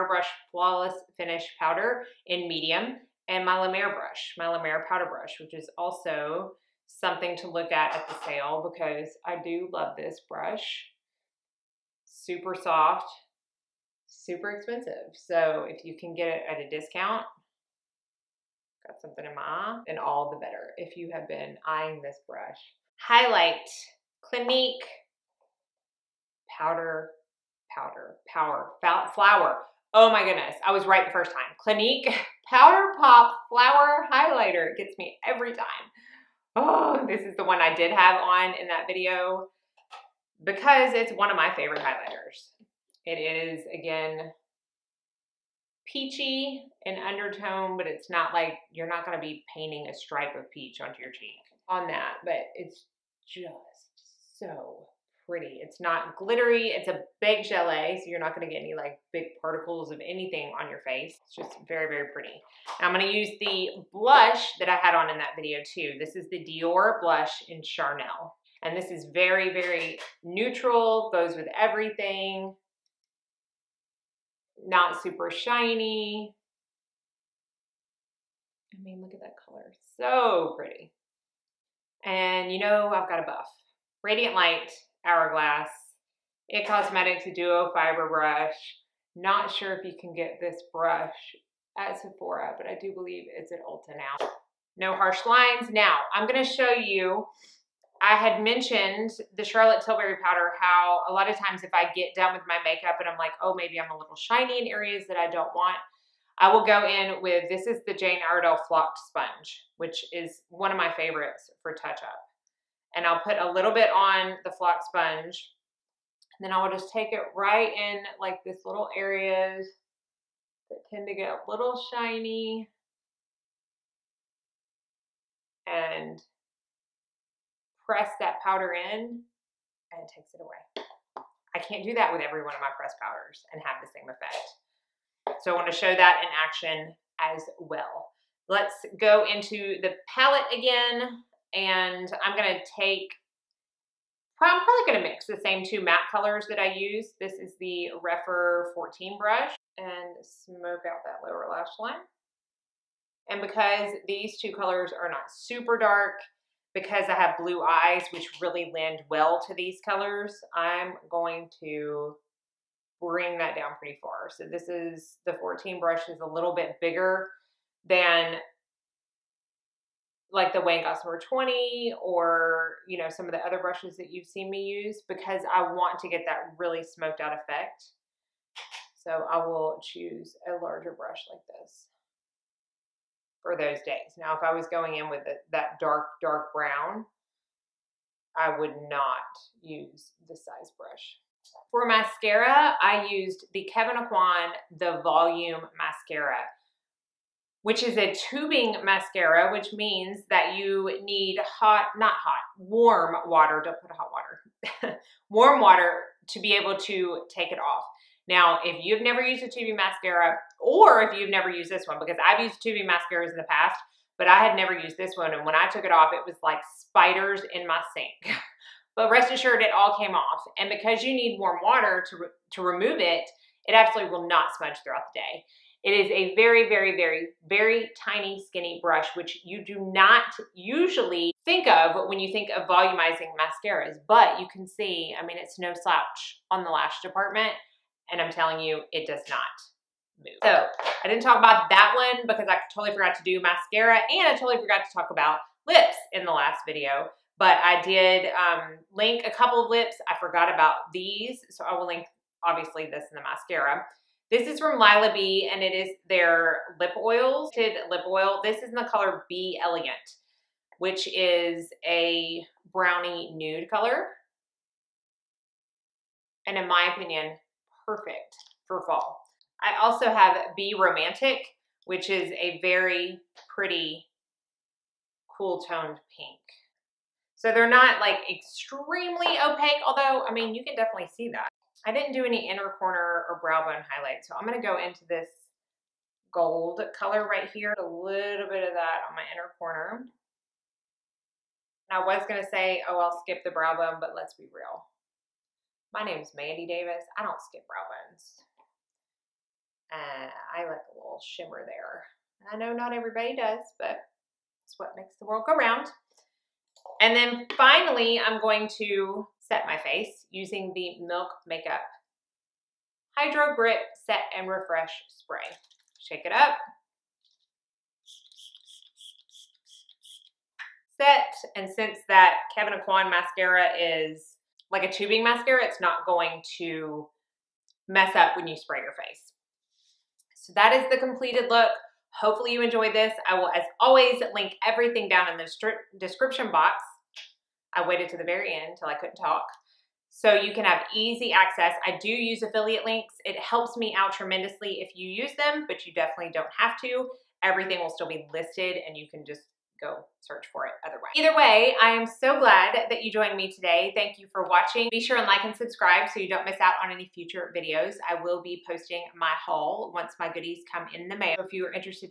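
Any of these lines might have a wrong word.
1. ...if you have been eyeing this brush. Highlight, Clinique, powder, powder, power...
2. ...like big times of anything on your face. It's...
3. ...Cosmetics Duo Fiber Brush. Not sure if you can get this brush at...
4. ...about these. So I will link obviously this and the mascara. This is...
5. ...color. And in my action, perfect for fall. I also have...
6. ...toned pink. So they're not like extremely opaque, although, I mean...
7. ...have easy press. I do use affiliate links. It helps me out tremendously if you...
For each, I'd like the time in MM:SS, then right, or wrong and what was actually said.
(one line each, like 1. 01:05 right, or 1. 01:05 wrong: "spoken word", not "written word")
1. 00:20 right
2. 00:58 wrong: "particles", not "times"
3. 01:26 right
4. 04:10 right
5. 04:23 wrong: "opinion", not "action"
6. 04:35 right
7. 05:40 wrong: "access", not "press".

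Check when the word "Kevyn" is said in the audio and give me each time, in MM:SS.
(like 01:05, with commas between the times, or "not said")
03:13, 05:22.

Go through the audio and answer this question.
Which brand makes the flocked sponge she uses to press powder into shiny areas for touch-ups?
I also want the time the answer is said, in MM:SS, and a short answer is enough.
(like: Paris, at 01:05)
Jane Iredale, at 01:47.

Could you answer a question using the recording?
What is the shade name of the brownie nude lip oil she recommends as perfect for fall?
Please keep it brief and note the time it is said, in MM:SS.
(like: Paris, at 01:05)
B Elegant, at 04:19.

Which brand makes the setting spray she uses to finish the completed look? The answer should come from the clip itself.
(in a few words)
Milk Makeup.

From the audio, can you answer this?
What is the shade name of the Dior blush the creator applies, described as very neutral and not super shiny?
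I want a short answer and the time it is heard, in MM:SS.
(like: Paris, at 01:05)
Charnel, at 01:07.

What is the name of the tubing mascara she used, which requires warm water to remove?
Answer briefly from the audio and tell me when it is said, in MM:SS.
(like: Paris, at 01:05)
The Volume Mascara, at 03:14.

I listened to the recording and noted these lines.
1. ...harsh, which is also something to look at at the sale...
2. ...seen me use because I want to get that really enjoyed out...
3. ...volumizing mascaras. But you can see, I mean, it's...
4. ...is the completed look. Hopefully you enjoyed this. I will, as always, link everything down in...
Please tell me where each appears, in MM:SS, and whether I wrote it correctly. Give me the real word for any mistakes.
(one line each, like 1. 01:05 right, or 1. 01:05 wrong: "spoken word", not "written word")
1. 00:05 wrong: "brush", not "harsh"
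2. 02:54 wrong: "smoked", not "enjoyed"
3. 03:52 right
4. 05:30 right.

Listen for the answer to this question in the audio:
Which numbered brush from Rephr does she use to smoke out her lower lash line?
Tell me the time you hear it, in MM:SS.
02:28.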